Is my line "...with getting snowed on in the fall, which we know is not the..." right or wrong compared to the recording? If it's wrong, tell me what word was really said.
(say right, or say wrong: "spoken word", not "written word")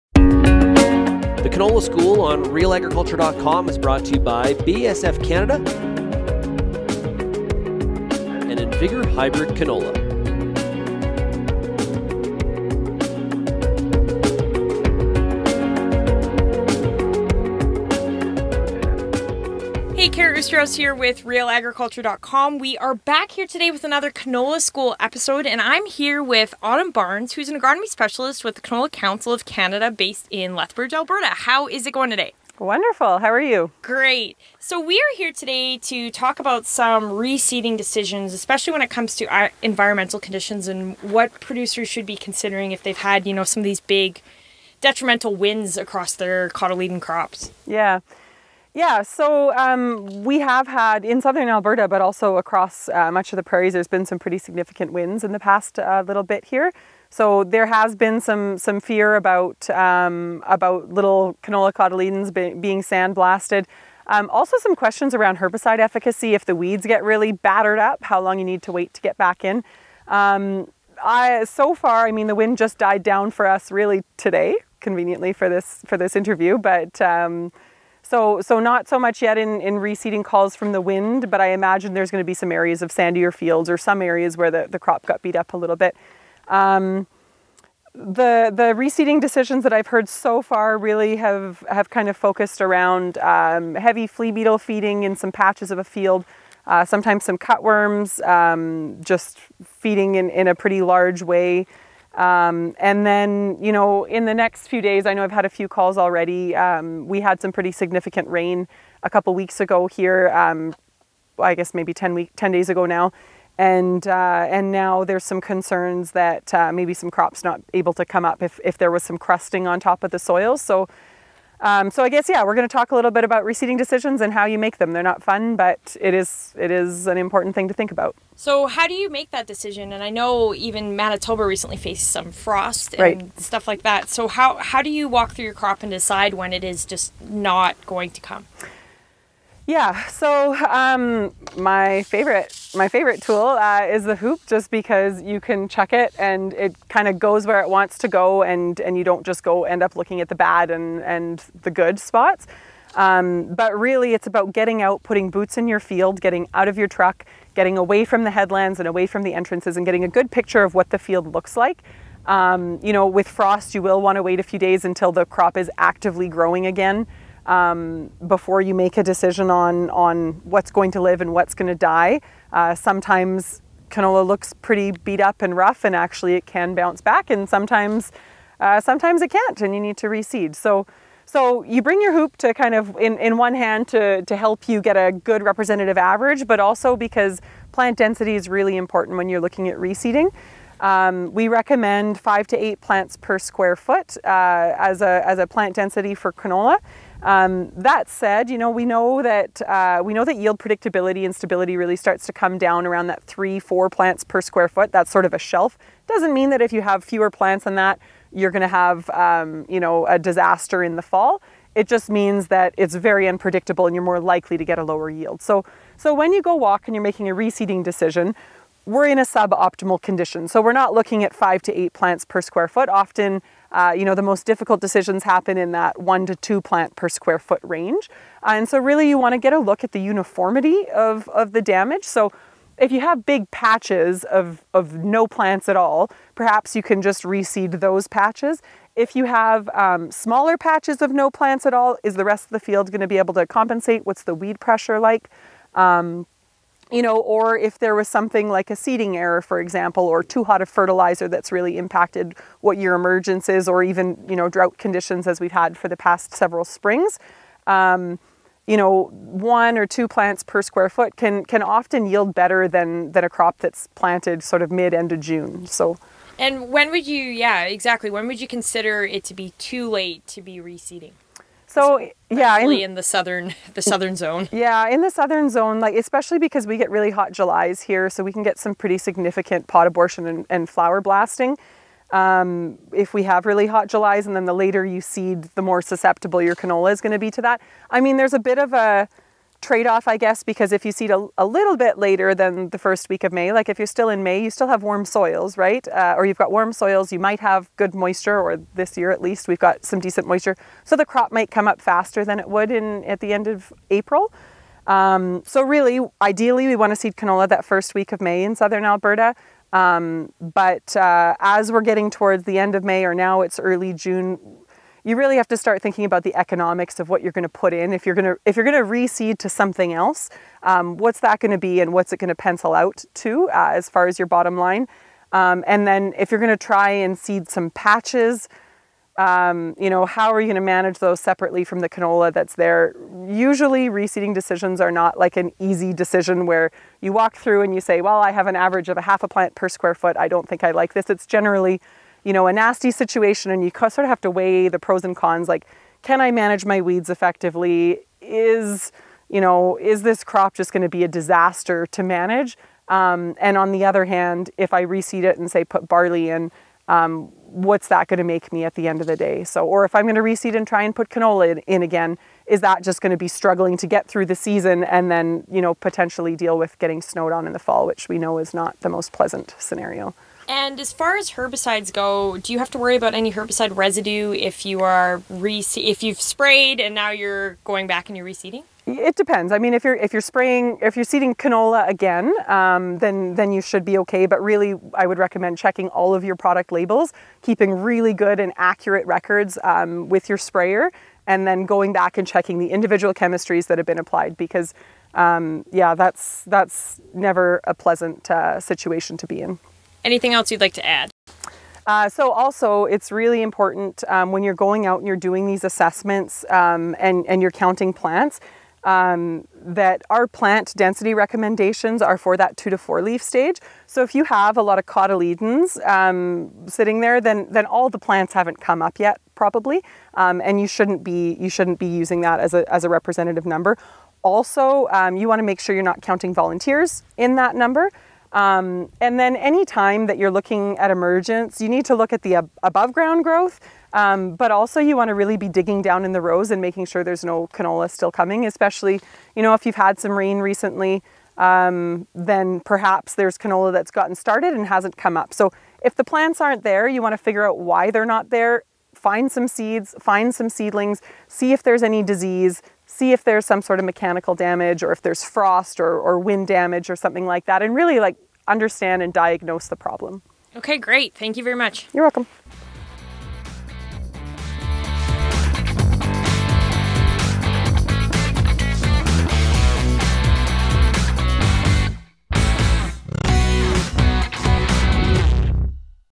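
right.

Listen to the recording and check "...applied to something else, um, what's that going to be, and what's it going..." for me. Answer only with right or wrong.
wrong.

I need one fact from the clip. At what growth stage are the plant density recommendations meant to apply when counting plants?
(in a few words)
2 to 4 leaf stage.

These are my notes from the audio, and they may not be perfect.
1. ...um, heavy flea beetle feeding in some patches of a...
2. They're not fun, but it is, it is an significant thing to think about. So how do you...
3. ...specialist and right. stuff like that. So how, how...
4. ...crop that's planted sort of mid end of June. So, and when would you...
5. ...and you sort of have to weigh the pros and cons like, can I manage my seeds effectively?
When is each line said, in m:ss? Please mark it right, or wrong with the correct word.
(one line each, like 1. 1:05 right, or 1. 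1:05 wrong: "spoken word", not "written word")
1. 1:33 right
2. 2:04 wrong: "important", not "significant"
3. 2:12 wrong: "frost", not "specialist"
4. 4:23 right
5. 5:43 wrong: "weeds", not "seeds".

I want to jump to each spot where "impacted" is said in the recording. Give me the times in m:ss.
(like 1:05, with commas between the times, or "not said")
4:11.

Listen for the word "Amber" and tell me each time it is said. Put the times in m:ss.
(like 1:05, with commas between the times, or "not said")
0:20.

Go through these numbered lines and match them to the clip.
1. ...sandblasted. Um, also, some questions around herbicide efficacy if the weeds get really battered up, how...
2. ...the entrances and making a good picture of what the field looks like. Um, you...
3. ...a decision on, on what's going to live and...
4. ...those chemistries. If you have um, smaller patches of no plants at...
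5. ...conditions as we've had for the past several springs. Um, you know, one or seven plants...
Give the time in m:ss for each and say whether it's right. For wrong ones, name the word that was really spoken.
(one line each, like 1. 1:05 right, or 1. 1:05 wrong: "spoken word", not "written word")
1. 1:02 right
2. 2:39 wrong: "getting", not "making"
3. 2:48 right
4. 3:57 wrong: "patches", not "chemistries"
5. 4:14 wrong: "two", not "seven".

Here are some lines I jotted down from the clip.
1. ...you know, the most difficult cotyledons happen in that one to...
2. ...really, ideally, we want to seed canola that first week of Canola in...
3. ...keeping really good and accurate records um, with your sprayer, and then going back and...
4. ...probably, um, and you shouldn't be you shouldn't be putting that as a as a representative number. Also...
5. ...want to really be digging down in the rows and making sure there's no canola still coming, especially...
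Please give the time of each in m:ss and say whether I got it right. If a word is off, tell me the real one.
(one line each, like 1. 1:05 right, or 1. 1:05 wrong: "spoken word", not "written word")
1. 3:43 wrong: "decisions", not "cotyledons"
2. 5:05 wrong: "May", not "Canola"
3. 6:27 right
4. 6:59 wrong: "using", not "putting"
5. 7:14 right.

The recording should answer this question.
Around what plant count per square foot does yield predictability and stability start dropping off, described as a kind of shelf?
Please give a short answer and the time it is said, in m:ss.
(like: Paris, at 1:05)
3 to 4, at 3:23.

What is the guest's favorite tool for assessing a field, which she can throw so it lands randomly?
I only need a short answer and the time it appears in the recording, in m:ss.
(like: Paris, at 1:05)
The hoop, at 2:24.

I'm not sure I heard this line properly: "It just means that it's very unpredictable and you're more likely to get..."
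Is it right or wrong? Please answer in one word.
right.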